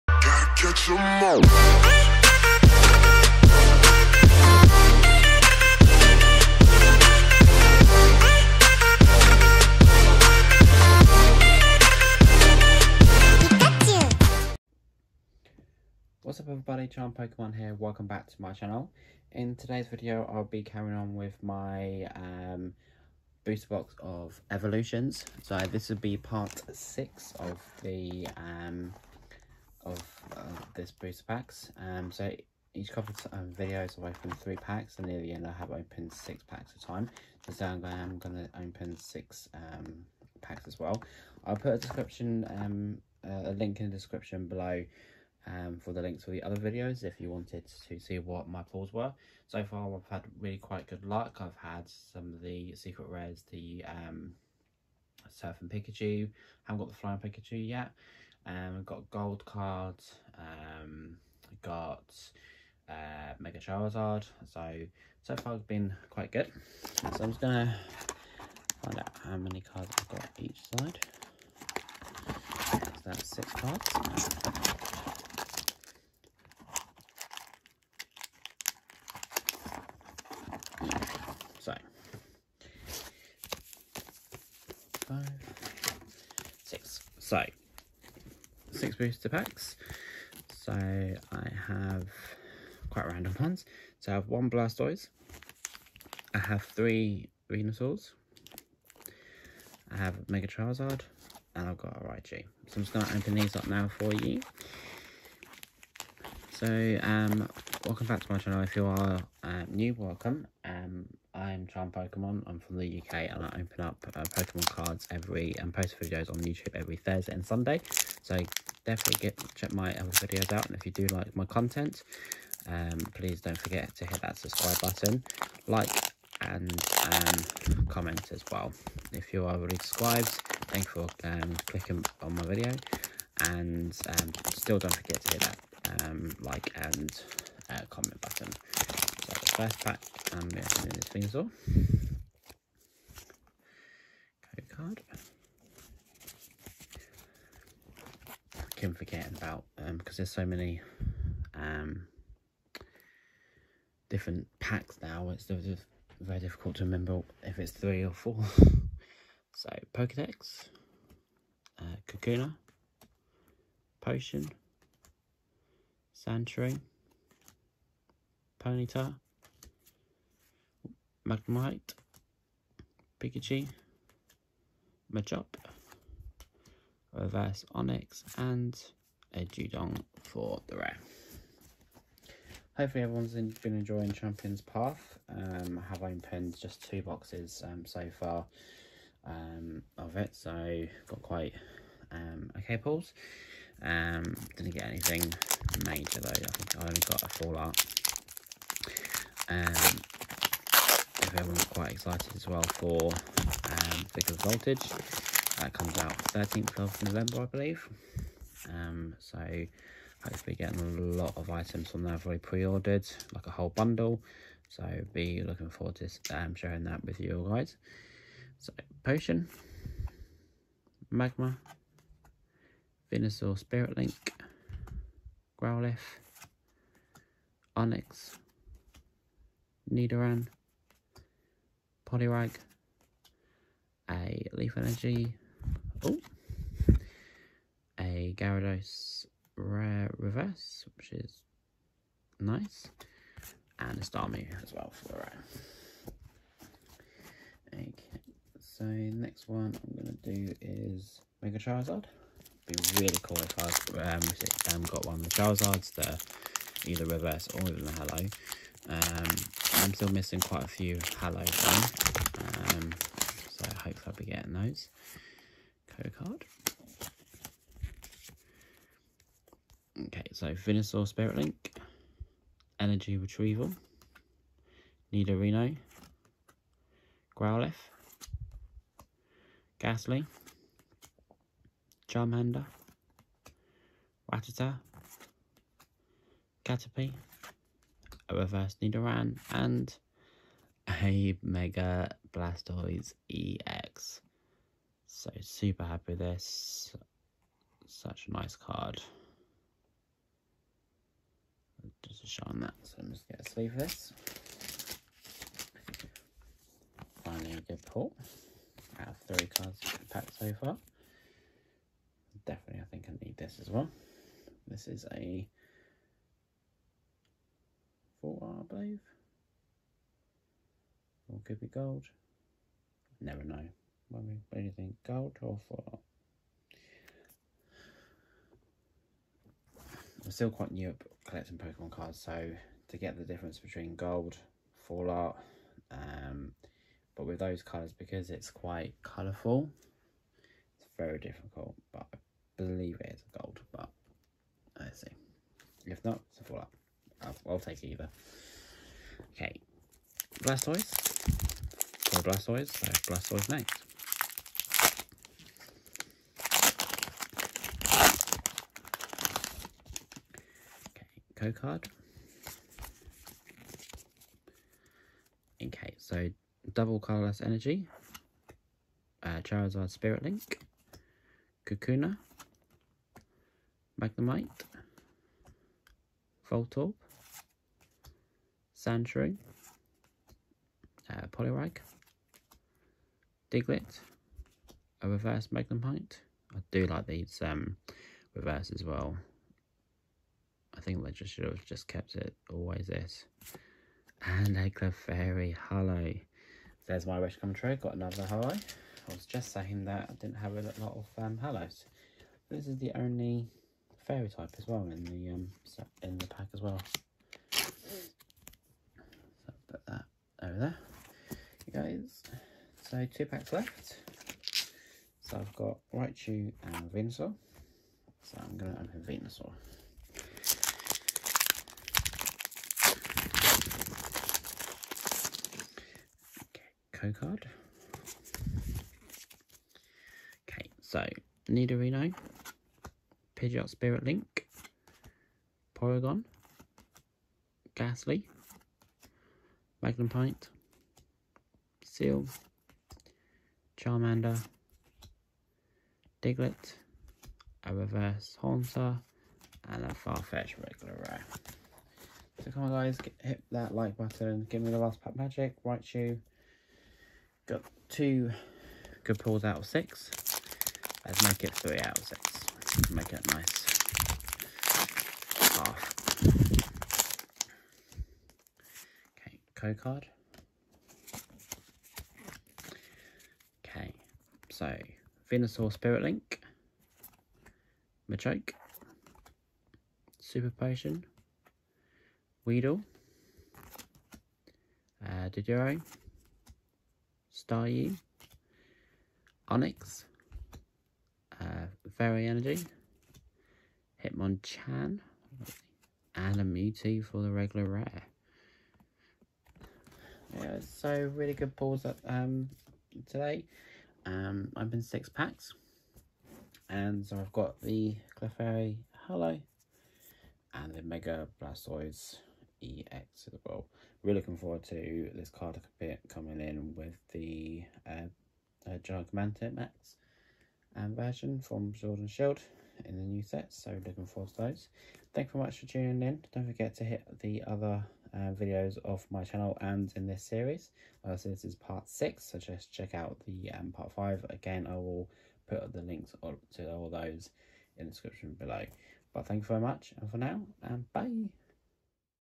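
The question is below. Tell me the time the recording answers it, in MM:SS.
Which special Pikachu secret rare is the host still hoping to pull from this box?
00:56.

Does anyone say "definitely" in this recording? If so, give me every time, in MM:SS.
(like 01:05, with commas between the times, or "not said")
01:58, 05:12.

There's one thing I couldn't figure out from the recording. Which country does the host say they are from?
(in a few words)
UK.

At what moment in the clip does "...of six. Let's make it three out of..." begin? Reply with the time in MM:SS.
07:39.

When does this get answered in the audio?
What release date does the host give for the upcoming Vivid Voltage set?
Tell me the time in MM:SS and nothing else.
03:26.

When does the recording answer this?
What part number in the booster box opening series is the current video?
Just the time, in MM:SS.
00:26.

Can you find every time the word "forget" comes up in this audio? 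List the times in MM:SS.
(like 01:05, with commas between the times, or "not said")
02:03, 02:14, 02:28, 08:46.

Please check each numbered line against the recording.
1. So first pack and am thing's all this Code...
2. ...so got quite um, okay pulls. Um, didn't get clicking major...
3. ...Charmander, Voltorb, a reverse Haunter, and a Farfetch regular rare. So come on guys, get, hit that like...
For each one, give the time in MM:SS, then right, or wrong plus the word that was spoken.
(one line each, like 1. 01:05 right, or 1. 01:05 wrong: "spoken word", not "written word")
1. 02:19 right
2. 03:10 wrong: "anything", not "clicking"
3. 07:23 wrong: "Diglett", not "Voltorb".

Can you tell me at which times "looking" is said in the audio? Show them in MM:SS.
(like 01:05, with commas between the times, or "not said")
03:35, 08:34, 08:43.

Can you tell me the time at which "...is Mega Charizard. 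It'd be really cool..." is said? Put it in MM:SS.
04:10.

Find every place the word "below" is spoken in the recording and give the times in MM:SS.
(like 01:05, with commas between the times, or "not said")
00:44, 08:58.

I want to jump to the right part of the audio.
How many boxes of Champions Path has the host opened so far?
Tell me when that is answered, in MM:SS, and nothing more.
03:06.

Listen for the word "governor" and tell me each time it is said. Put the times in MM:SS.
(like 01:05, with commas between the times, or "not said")
not said.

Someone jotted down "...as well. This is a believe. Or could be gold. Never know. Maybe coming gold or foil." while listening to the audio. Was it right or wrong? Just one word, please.
wrong.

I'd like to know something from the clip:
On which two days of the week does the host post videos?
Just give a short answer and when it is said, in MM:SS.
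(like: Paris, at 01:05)
Thursday and Sunday, at 01:56.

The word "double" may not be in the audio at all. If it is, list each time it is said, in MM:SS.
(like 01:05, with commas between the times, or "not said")
06:06.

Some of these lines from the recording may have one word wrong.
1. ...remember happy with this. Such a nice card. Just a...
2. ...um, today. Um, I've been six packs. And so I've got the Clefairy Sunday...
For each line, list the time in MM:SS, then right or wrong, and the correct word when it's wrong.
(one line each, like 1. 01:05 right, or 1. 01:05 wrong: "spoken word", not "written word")
1. 04:55 wrong: "super", not "remember"
2. 08:22 wrong: "Holo", not "Sunday".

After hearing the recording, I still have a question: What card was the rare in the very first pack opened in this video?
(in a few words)
Dewgong.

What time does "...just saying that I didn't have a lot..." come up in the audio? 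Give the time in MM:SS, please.
06:39.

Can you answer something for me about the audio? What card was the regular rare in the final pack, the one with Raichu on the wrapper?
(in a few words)
Mewtwo.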